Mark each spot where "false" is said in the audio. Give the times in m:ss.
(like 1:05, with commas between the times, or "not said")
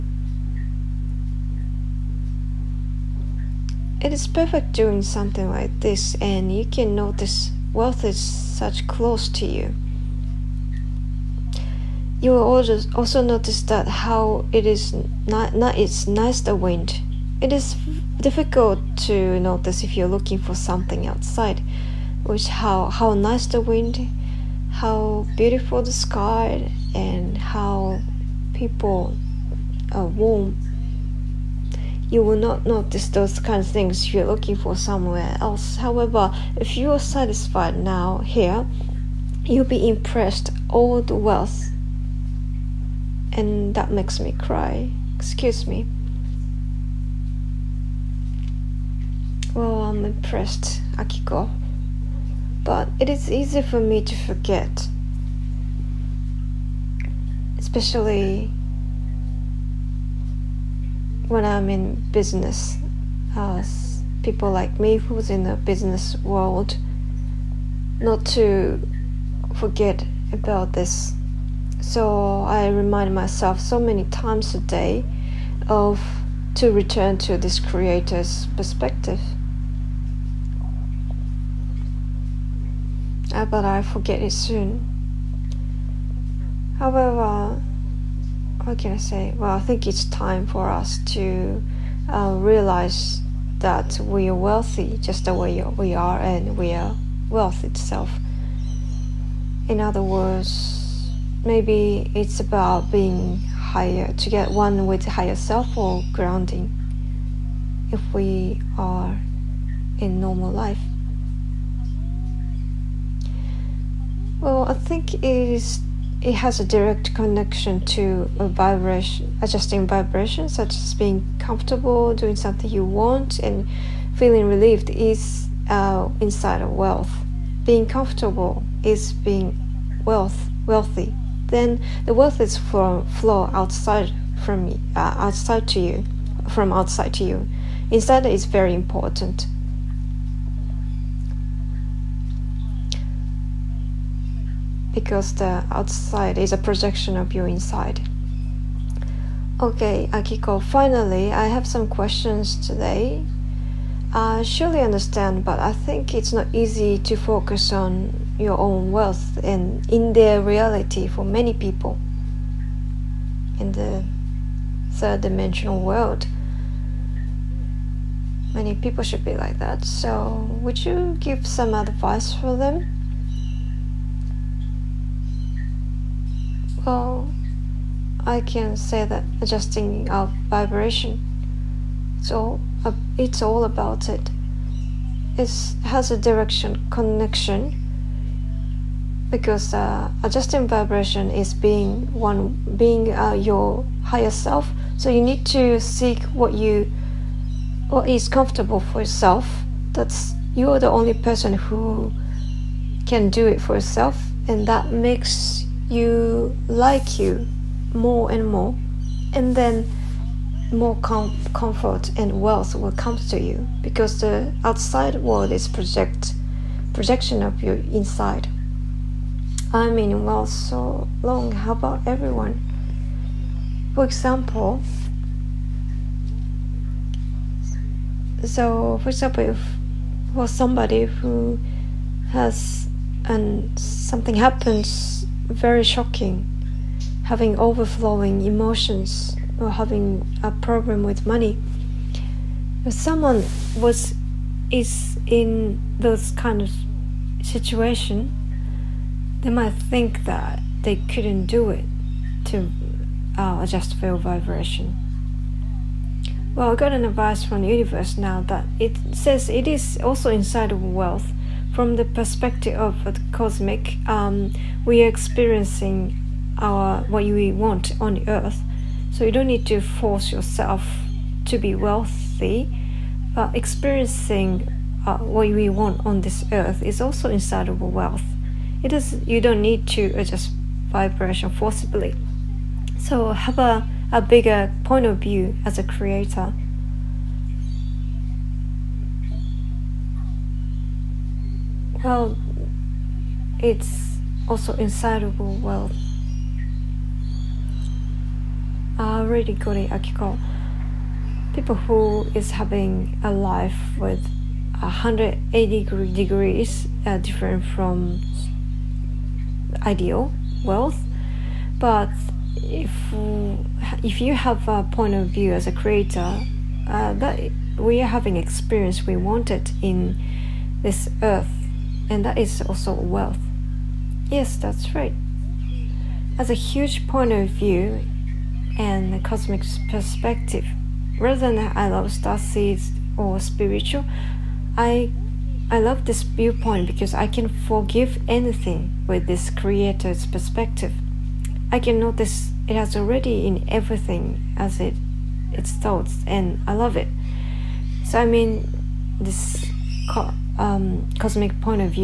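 not said.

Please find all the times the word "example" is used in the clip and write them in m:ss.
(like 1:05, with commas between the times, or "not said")
3:44, 3:49.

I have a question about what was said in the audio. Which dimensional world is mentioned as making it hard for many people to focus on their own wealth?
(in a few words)
third dimensional world.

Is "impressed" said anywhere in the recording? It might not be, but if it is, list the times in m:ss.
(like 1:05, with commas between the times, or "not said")
0:39, 0:50.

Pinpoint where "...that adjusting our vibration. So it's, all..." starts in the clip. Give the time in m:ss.
2:59.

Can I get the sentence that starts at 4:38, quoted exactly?
It is you don't need to adjust vibration forcibly.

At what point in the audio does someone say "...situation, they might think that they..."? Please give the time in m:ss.
4:07.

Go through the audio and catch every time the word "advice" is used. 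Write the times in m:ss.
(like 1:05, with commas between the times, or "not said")
2:51, 4:17.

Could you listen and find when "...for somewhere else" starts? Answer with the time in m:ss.
0:34.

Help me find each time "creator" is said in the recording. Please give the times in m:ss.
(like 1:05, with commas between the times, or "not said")
1:17, 4:45, 5:15, 5:39.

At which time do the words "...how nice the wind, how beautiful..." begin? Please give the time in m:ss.
0:22.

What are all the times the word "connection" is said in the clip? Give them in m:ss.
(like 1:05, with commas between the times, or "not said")
1:57, 3:06.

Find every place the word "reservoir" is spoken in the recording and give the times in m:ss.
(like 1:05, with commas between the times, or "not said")
not said.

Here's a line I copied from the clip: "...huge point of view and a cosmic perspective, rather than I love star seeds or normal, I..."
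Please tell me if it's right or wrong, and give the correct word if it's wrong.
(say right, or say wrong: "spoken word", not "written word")
wrong: "spiritual", not "normal".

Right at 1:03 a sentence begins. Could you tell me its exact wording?
As people like me who's in the business world, not to forget about this.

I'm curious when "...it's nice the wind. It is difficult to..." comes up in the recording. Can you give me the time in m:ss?
0:15.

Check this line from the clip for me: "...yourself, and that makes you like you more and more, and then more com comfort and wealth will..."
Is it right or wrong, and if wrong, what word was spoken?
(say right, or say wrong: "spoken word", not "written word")
right.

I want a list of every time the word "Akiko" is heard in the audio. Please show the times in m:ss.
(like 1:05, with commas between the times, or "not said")
0:50, 2:30, 4:59.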